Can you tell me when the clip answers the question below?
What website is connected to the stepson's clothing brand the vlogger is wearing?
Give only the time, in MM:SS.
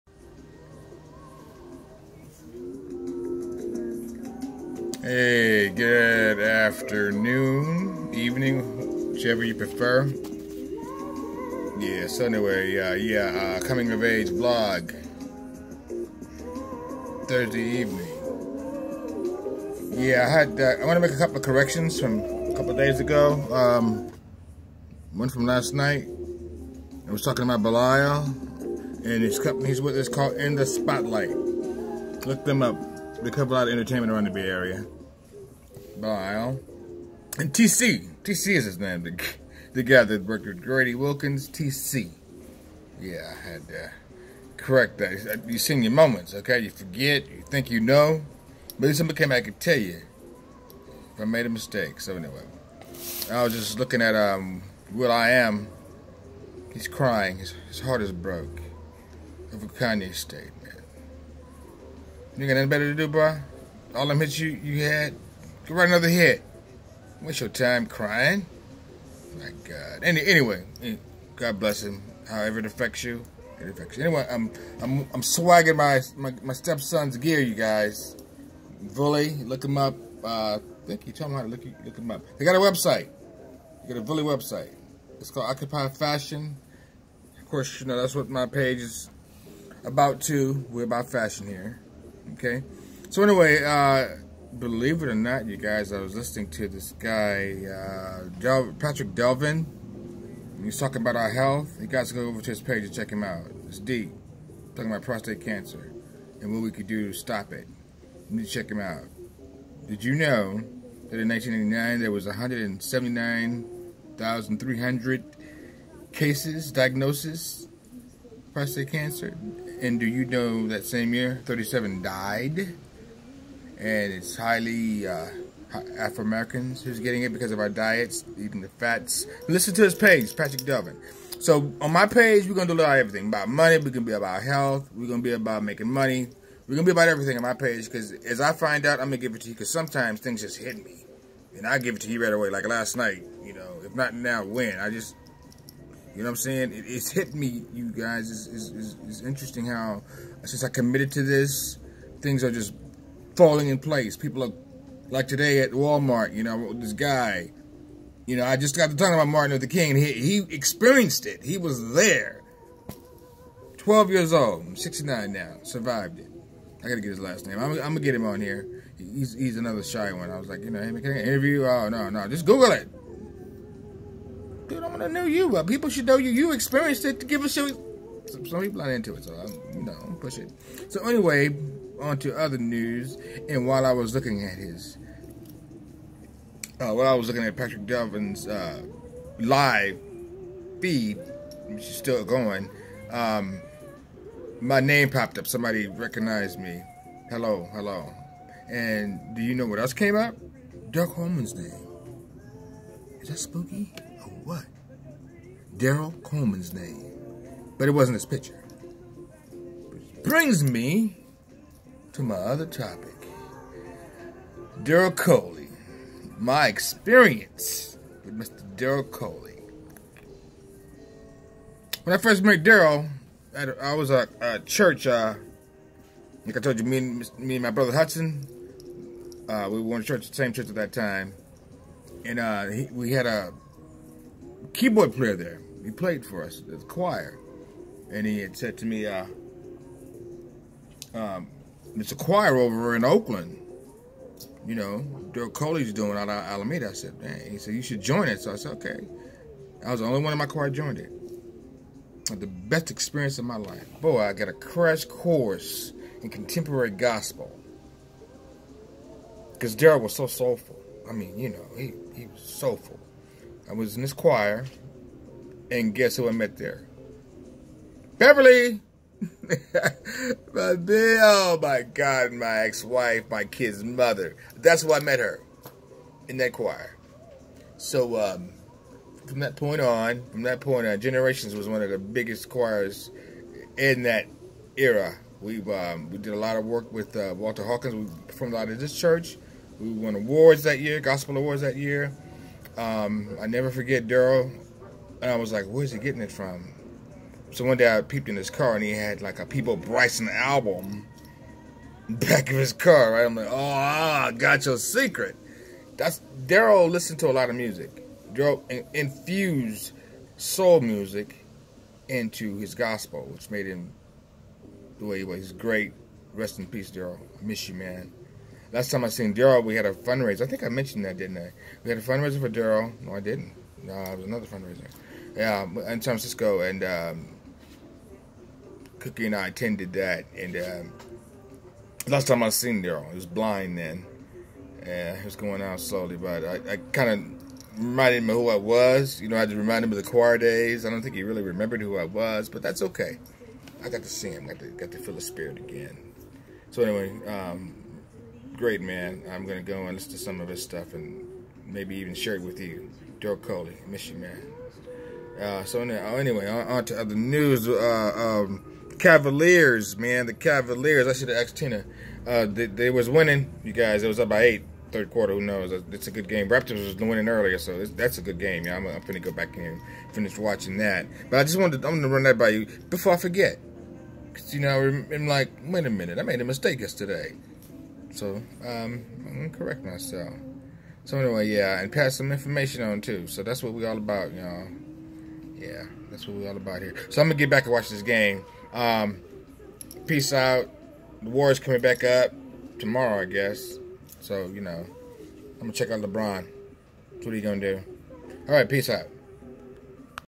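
01:25.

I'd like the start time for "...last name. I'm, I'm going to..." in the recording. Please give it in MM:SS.
02:47.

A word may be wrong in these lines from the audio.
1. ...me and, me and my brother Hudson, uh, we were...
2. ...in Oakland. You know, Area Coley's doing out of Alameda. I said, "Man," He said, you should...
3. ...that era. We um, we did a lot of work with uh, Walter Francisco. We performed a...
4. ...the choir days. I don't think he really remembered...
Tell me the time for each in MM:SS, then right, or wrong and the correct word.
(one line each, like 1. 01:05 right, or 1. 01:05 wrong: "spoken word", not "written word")
1. 03:46 right
2. 04:02 wrong: "Daryl", not "Area"
3. 04:44 wrong: "Hawkins", not "Francisco"
4. 05:39 right.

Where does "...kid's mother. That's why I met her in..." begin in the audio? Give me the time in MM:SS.
04:33.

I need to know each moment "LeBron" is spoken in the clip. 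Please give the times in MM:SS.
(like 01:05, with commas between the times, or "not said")
06:36.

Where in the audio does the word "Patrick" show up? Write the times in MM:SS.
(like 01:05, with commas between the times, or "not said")
01:38, 02:10, 03:07.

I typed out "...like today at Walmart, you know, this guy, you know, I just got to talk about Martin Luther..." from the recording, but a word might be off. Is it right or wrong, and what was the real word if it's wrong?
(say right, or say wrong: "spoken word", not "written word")
right.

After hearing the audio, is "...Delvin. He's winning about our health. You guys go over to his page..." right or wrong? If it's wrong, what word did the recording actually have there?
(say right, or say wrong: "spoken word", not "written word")
wrong: "talking", not "winning".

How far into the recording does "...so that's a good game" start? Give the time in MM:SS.
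06:07.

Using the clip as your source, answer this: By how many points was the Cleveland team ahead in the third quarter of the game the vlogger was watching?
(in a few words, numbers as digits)
8.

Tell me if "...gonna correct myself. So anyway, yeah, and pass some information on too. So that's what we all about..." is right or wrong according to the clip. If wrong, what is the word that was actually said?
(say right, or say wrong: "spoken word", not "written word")
right.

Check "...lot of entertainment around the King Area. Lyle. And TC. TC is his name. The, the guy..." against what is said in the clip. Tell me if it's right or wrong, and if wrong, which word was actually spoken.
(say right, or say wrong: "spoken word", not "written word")
wrong: "Bay", not "King".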